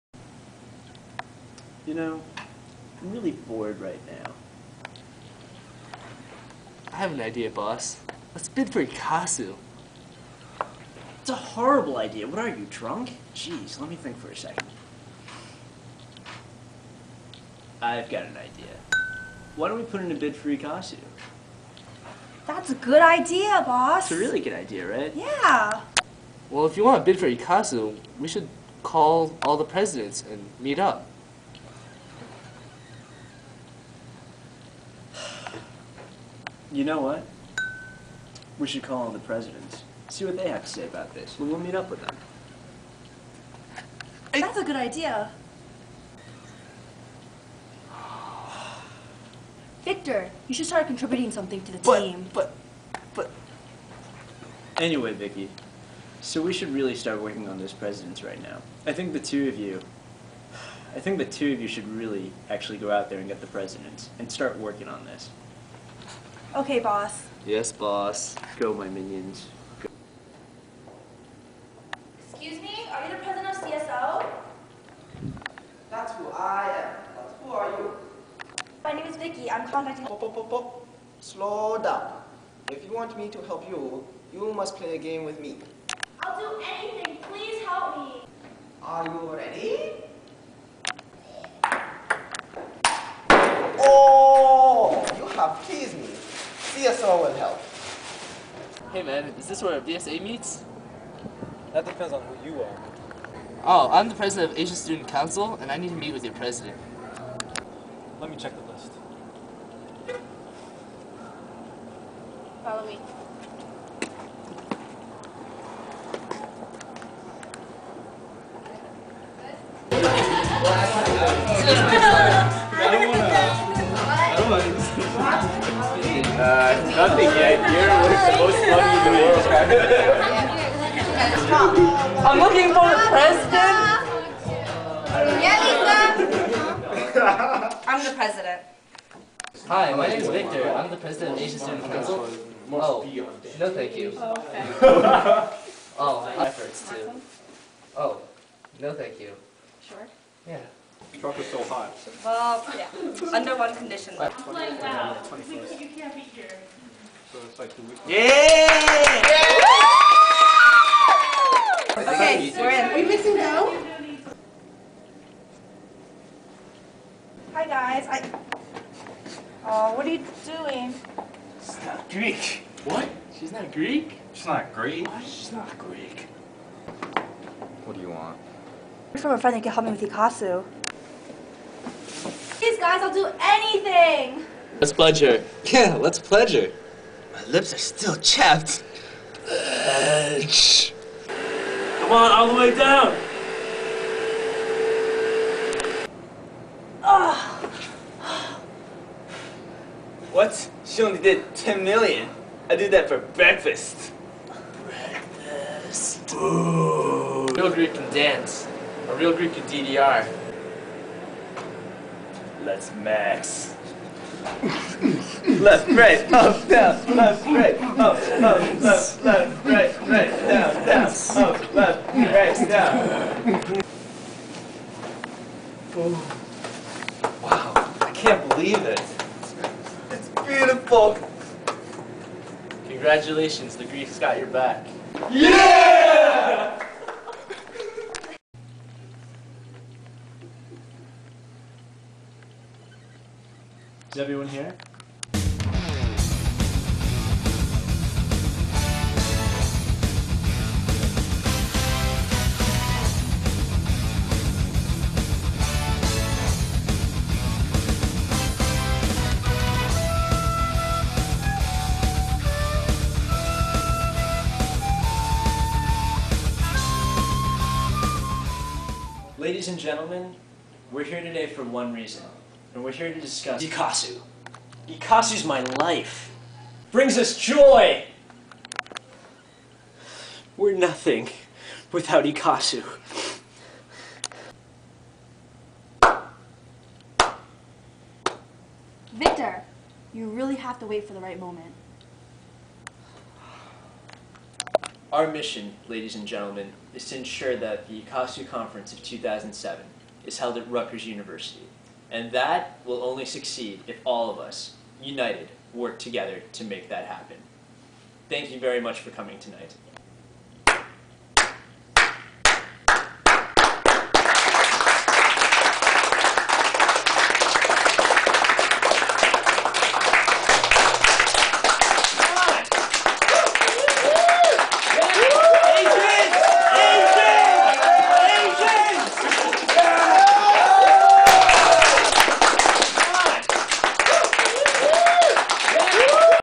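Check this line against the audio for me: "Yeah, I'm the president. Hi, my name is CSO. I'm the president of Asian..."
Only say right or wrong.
wrong.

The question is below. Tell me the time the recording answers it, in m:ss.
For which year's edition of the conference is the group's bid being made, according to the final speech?
4:59.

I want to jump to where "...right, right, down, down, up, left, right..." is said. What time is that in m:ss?
3:39.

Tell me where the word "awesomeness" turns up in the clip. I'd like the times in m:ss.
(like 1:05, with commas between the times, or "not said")
not said.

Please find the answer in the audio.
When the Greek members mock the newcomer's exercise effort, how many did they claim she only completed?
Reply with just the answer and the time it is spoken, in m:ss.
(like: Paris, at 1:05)
10 million, at 3:21.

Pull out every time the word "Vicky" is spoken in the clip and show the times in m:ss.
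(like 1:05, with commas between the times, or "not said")
0:55, 1:19.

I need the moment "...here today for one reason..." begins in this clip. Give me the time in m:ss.
4:31.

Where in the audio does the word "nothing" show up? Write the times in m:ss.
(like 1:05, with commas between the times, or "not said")
2:06, 4:40.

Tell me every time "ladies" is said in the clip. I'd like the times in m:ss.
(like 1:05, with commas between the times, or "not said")
4:29, 4:55.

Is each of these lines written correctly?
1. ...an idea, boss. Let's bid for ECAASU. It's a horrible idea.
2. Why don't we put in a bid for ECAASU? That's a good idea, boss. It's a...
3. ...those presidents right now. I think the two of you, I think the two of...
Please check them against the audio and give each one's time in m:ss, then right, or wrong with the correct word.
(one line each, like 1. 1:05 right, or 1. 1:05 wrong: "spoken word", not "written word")
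1. 0:07 right
2. 0:19 right
3. 0:57 right.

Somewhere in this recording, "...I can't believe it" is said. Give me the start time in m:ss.
3:47.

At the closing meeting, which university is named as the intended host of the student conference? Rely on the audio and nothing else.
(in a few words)
Rutgers University.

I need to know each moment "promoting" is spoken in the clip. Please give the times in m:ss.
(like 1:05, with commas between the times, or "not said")
not said.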